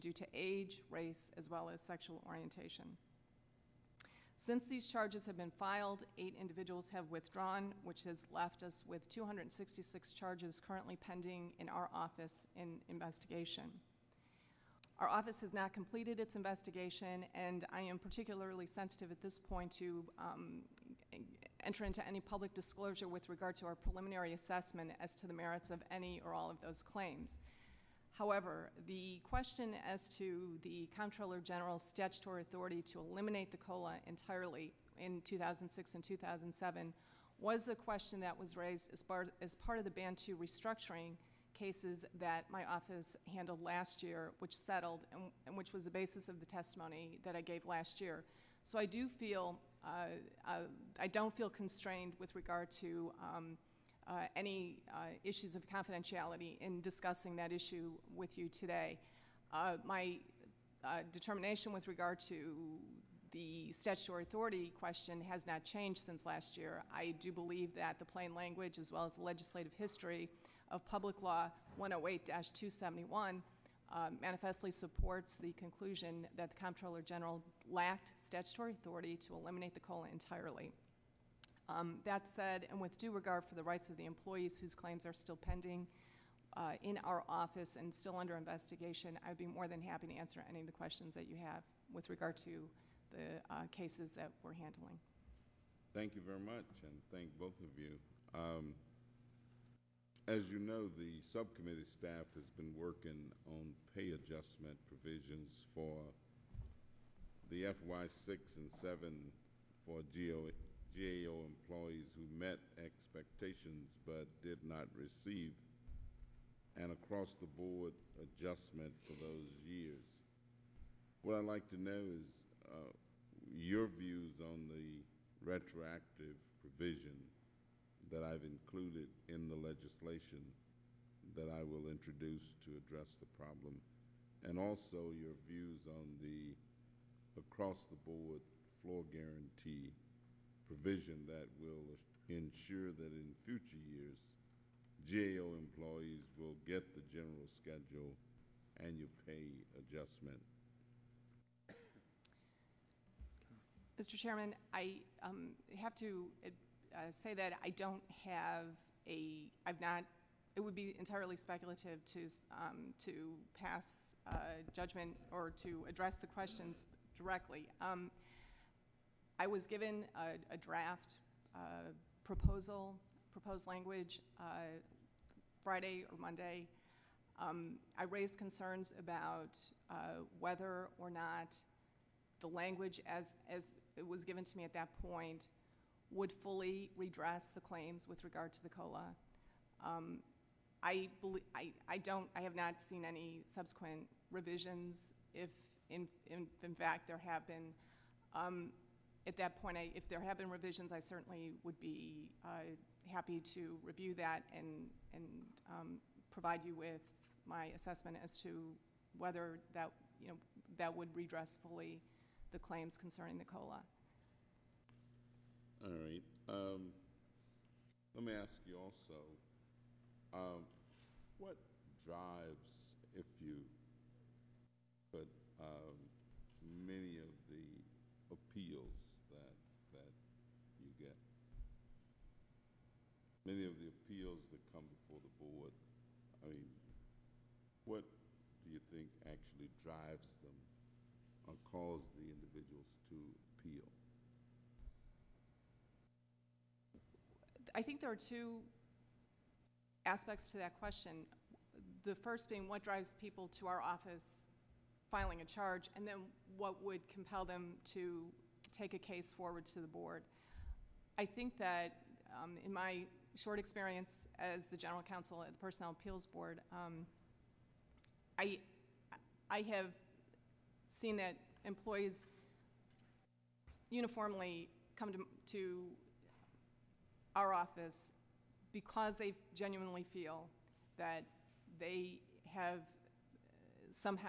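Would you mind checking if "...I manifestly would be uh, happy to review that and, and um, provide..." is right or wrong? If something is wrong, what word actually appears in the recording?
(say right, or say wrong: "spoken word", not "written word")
wrong: "certainly", not "manifestly".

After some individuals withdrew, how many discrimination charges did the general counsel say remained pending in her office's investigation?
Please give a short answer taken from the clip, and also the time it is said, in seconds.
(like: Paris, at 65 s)
266, at 9 s.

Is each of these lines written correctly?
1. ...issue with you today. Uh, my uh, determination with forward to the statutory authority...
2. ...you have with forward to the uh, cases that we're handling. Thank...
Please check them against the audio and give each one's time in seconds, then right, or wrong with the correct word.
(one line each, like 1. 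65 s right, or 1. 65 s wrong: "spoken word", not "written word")
1. 57 s wrong: "regard", not "forward"
2. 91 s wrong: "regard", not "forward".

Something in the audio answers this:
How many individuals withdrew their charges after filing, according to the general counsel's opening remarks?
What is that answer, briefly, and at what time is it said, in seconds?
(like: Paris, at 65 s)
8, at 6 s.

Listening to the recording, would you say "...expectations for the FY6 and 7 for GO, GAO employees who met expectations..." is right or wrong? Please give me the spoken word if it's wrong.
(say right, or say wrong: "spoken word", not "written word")
wrong: "provisions", not "expectations".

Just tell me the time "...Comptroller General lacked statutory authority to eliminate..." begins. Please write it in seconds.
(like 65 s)
76 s.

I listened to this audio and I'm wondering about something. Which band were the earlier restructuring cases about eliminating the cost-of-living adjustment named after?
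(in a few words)
Band 2.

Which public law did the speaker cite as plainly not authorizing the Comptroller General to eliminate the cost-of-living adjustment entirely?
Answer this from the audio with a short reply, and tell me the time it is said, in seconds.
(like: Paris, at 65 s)
Public Law 108-271, at 70 s.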